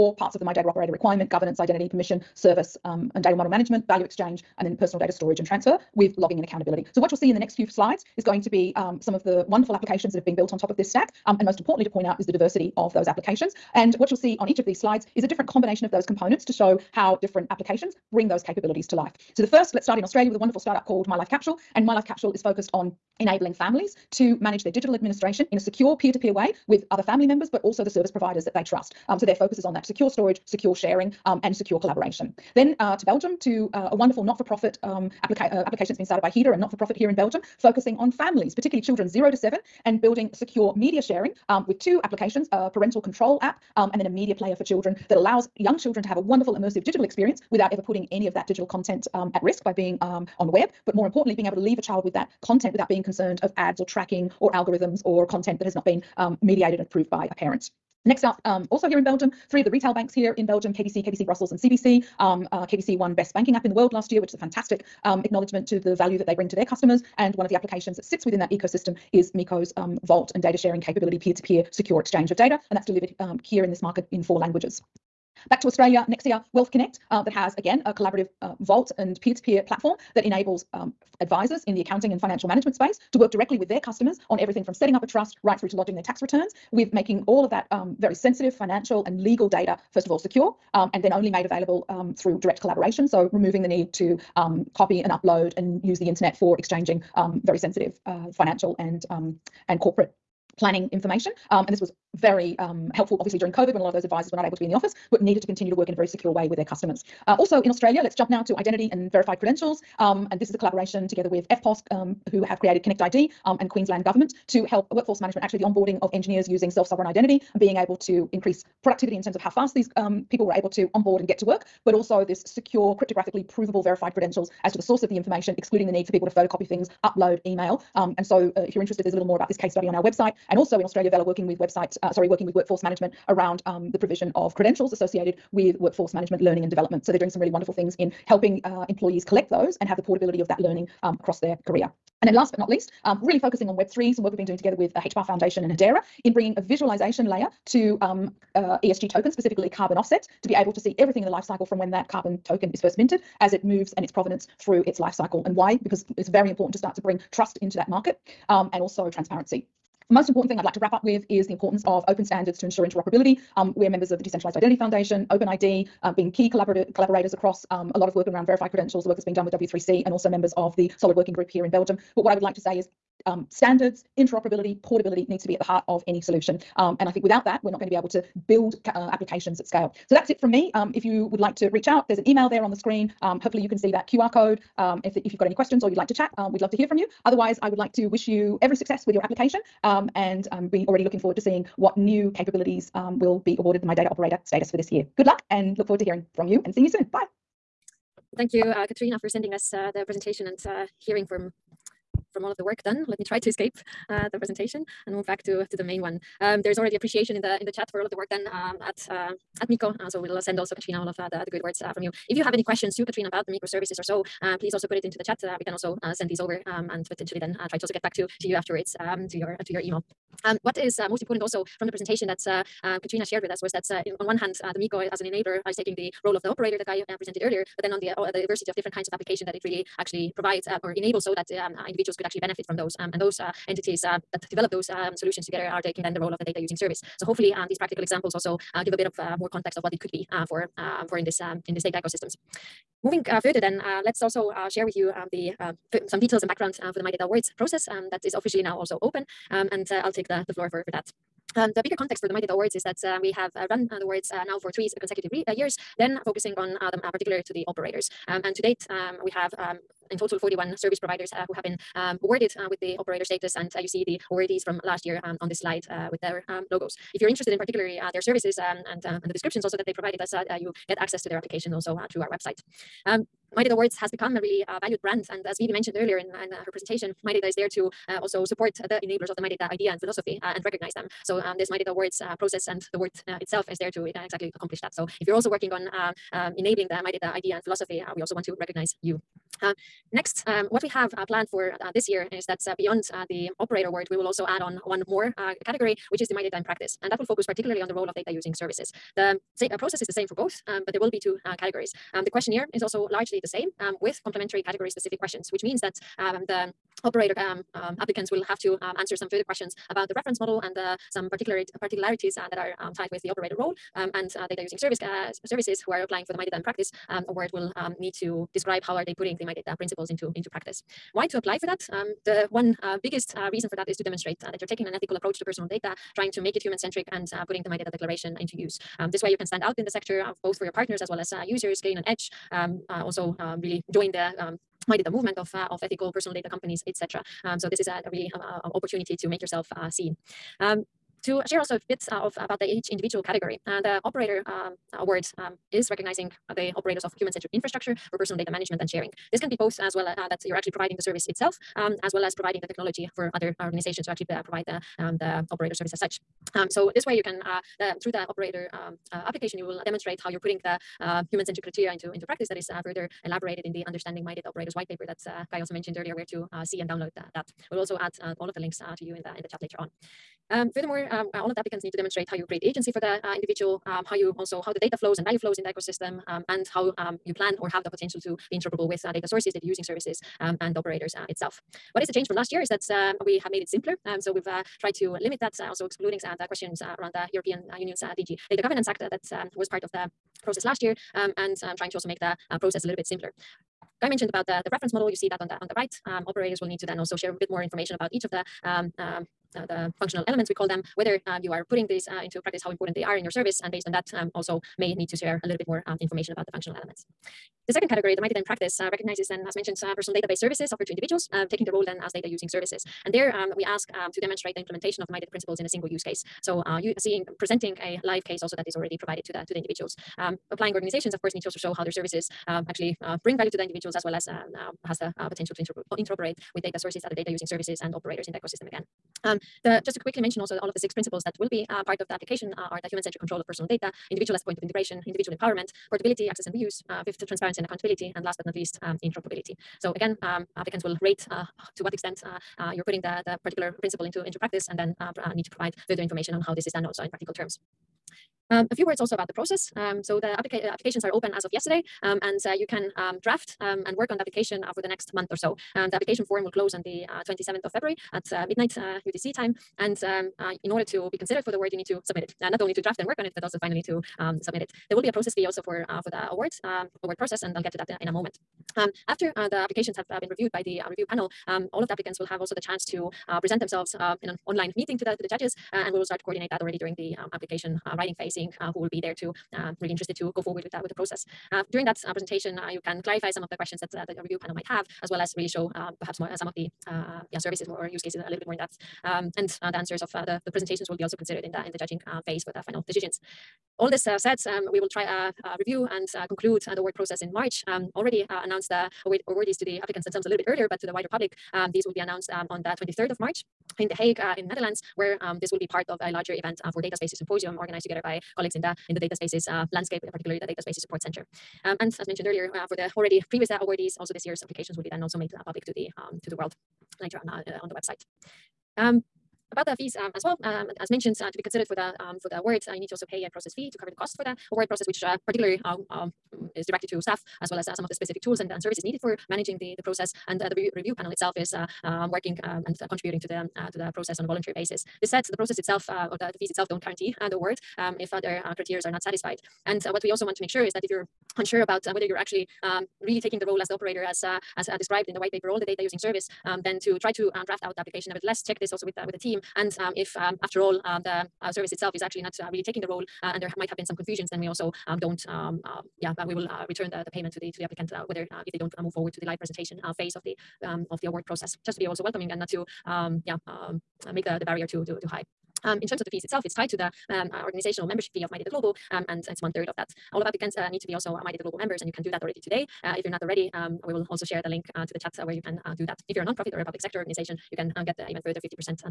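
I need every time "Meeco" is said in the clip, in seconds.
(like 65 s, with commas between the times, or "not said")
69 s, 209 s, 224 s.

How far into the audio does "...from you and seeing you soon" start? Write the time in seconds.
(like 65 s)
196 s.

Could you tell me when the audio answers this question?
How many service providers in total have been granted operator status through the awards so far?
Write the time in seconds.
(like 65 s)
260 s.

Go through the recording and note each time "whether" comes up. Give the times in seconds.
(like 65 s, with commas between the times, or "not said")
400 s, 541 s, 558 s.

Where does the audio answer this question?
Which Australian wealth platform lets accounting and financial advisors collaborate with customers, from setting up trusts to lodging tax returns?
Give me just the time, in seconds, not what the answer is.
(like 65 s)
76 s.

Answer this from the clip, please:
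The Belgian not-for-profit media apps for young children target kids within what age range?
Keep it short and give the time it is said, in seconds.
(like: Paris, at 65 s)
0 to 7, at 39 s.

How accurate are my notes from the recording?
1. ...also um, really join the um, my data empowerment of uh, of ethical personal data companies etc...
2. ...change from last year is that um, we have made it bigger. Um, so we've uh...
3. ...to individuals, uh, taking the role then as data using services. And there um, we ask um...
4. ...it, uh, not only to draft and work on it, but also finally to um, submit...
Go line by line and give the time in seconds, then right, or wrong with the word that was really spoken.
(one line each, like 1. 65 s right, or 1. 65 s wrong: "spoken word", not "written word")
1. 332 s wrong: "movement", not "empowerment"
2. 382 s wrong: "simpler", not "bigger"
3. 410 s right
4. 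462 s right.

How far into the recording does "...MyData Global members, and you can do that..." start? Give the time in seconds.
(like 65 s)
571 s.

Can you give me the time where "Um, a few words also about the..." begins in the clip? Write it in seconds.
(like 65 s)
448 s.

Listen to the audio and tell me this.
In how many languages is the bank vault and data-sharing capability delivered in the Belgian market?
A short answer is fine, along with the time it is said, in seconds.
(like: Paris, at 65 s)
4, at 74 s.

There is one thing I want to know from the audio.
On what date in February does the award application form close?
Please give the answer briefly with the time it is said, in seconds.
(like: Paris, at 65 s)
27 February, at 457 s.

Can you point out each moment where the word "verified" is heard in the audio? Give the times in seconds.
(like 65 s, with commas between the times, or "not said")
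109 s, 123 s, 168 s.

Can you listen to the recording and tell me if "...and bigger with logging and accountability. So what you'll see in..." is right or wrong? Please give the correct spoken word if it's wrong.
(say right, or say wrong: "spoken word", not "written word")
wrong: "transfer", not "bigger".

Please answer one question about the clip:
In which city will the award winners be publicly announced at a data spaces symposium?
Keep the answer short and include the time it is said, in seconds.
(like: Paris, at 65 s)
The Hague, at 503 s.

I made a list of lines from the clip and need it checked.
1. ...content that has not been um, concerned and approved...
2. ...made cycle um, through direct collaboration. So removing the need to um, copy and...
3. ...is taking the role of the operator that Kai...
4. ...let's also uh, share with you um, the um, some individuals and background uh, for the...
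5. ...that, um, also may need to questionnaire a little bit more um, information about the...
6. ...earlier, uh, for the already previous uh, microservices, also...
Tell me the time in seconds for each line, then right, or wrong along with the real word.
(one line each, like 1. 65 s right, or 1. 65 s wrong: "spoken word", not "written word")
1. 55 s wrong: "mediated", not "concerned"
2. 91 s wrong: "available", not "cycle"
3. 225 s right
4. 244 s wrong: "details", not "individuals"
5. 403 s wrong: "share", not "questionnaire"
6. 512 s wrong: "awardees", not "microservices".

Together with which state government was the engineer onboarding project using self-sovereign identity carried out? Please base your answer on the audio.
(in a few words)
Queensland Government.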